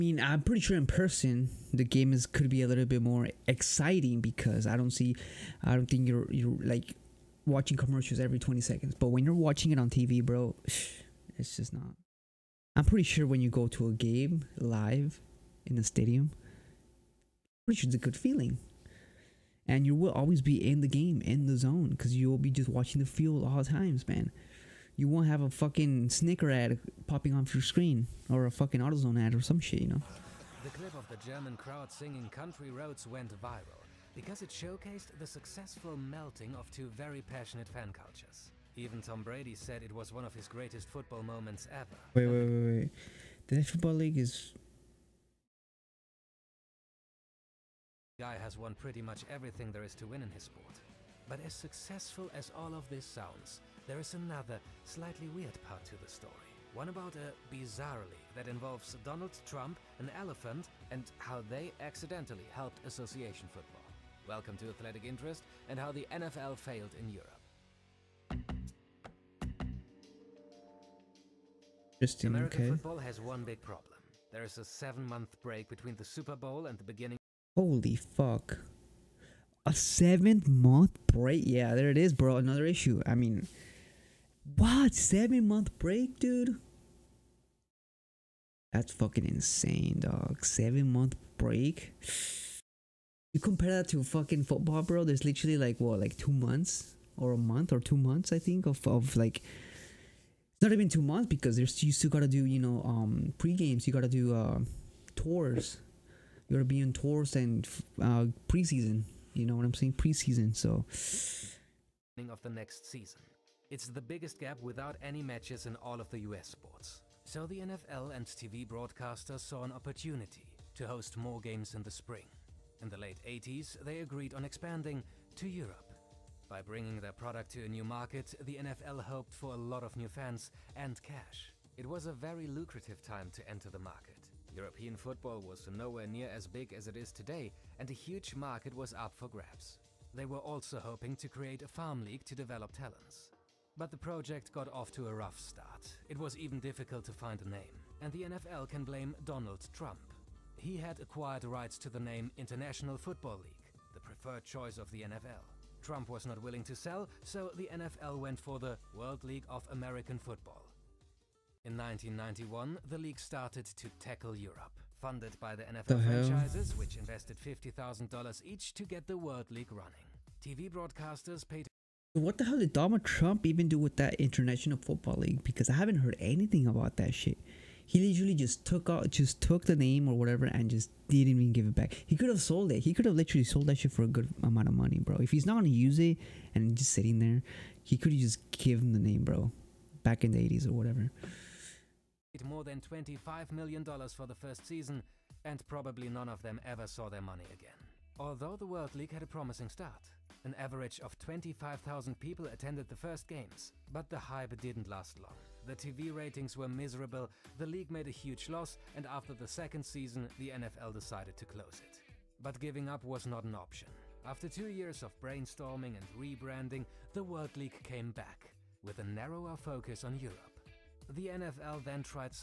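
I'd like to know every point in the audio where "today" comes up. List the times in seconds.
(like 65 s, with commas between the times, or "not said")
137 s.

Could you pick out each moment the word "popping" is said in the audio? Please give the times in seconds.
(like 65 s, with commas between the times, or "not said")
27 s.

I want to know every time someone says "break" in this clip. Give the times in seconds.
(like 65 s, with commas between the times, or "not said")
75 s, 81 s, 85 s, 91 s.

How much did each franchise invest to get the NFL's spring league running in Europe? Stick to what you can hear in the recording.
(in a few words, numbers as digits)
$50,000.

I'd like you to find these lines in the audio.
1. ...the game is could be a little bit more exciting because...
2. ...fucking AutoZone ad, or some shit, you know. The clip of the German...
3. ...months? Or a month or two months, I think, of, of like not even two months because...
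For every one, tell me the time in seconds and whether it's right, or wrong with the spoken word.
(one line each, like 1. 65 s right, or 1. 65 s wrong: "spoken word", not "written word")
1. 1 s right
2. 28 s right
3. 96 s right.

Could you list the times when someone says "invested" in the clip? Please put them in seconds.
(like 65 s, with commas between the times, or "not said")
166 s.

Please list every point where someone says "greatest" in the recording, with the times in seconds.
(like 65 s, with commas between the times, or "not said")
40 s.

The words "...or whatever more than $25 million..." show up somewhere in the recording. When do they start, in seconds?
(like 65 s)
190 s.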